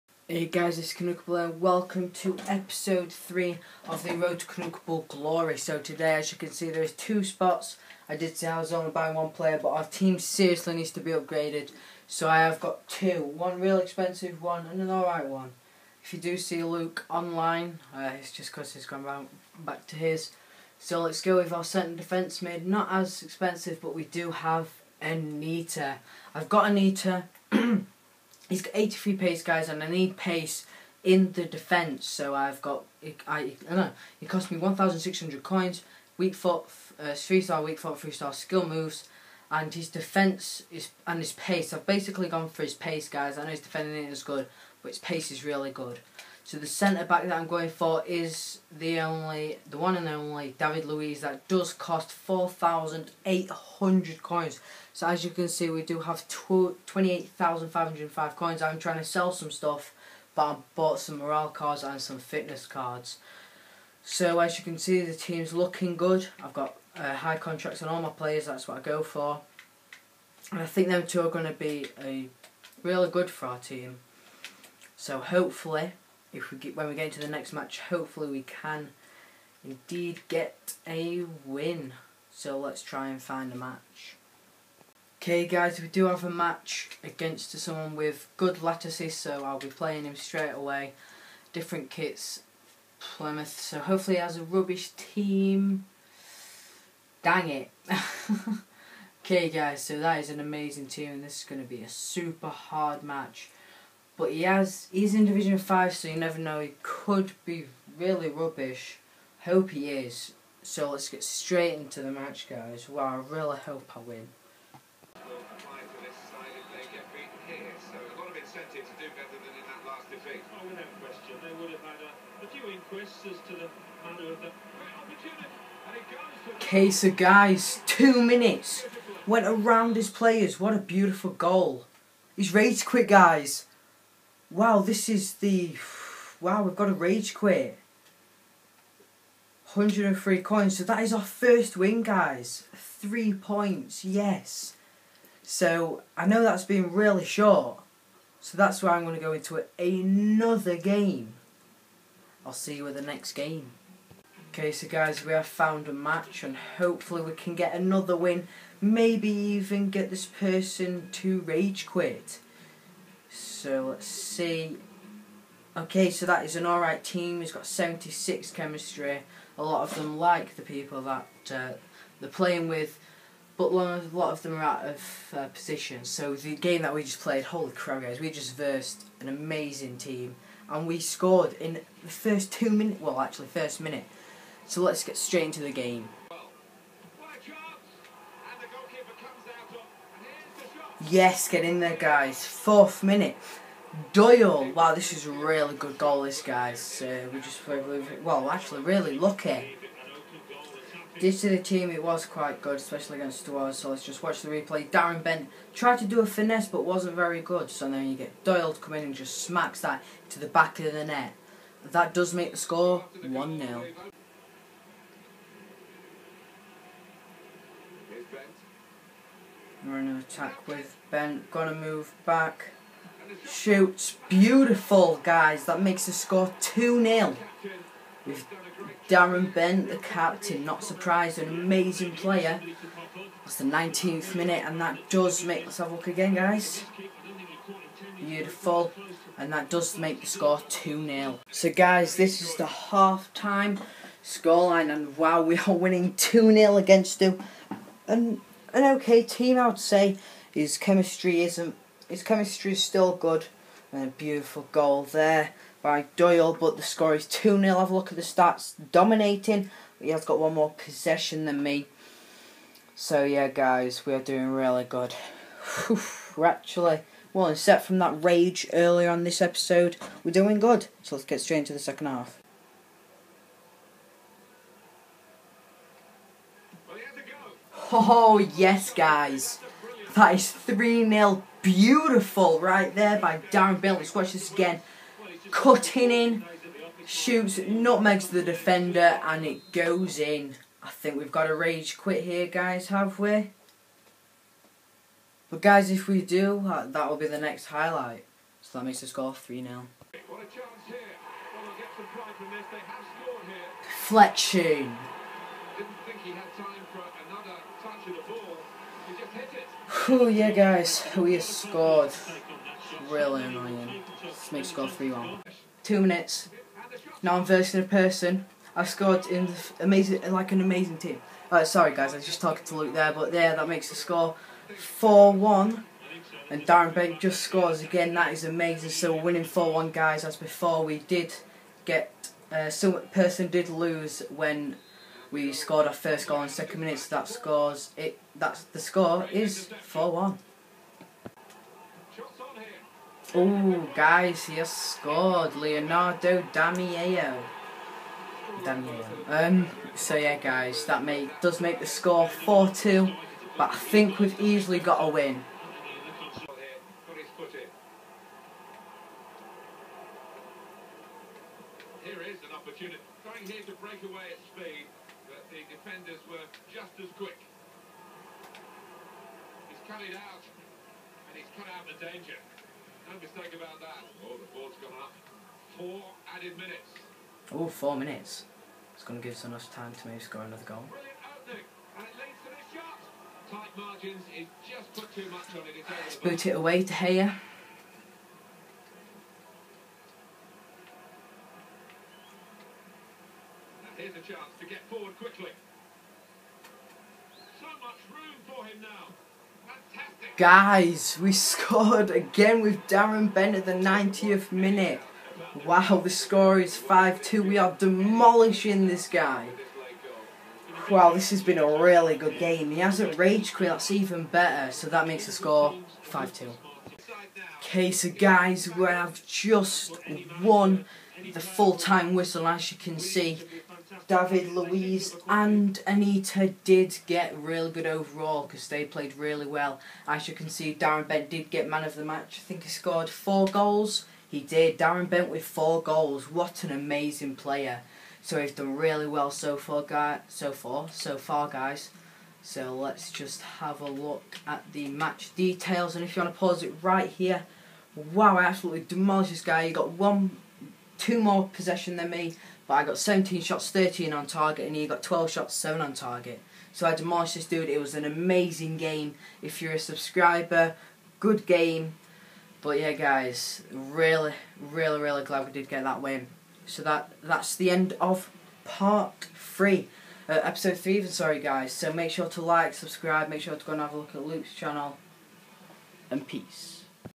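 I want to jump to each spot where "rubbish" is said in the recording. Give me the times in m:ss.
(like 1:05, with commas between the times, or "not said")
1:34, 1:48.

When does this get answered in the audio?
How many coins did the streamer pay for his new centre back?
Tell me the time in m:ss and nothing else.
0:52.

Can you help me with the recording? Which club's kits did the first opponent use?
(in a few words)
Plymouth.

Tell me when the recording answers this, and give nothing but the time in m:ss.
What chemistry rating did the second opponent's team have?
2:47.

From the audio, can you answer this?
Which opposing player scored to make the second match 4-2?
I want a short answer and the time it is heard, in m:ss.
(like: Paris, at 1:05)
Leonardo Damiao, at 5:45.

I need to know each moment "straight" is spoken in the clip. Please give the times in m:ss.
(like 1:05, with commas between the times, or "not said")
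1:30, 1:51, 3:05, 4:31.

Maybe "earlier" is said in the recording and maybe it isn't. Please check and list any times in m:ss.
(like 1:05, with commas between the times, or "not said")
4:28.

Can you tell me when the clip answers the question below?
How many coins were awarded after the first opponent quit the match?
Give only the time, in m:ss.
2:19.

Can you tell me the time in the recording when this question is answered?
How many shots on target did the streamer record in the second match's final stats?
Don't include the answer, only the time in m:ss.
7:33.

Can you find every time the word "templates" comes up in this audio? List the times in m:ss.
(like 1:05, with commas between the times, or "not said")
not said.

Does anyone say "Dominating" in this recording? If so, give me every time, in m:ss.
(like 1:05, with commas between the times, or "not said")
4:18.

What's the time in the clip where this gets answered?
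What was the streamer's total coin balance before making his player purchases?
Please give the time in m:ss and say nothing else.
0:56.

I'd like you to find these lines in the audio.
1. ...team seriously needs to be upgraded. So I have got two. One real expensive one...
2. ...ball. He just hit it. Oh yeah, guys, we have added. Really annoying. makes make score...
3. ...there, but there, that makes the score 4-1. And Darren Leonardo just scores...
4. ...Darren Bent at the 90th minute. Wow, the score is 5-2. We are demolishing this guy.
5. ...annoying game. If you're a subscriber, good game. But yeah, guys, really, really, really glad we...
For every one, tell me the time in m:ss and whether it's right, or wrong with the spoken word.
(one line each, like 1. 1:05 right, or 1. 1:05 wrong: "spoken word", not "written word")
1. 0:09 right
2. 5:08 wrong: "scored", not "added"
3. 5:22 wrong: "Bent", not "Leonardo"
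4. 6:42 right
5. 7:38 wrong: "amazing", not "annoying".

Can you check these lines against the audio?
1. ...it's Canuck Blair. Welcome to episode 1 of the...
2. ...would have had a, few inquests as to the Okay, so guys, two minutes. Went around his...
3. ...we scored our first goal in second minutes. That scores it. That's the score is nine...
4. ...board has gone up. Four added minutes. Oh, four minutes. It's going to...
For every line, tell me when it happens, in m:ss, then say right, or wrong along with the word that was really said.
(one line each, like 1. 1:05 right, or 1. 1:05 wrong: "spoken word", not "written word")
1. 0:00 wrong: "3", not "1"
2. 2:01 right
3. 5:35 wrong: "four", not "nine"
4. 6:14 right.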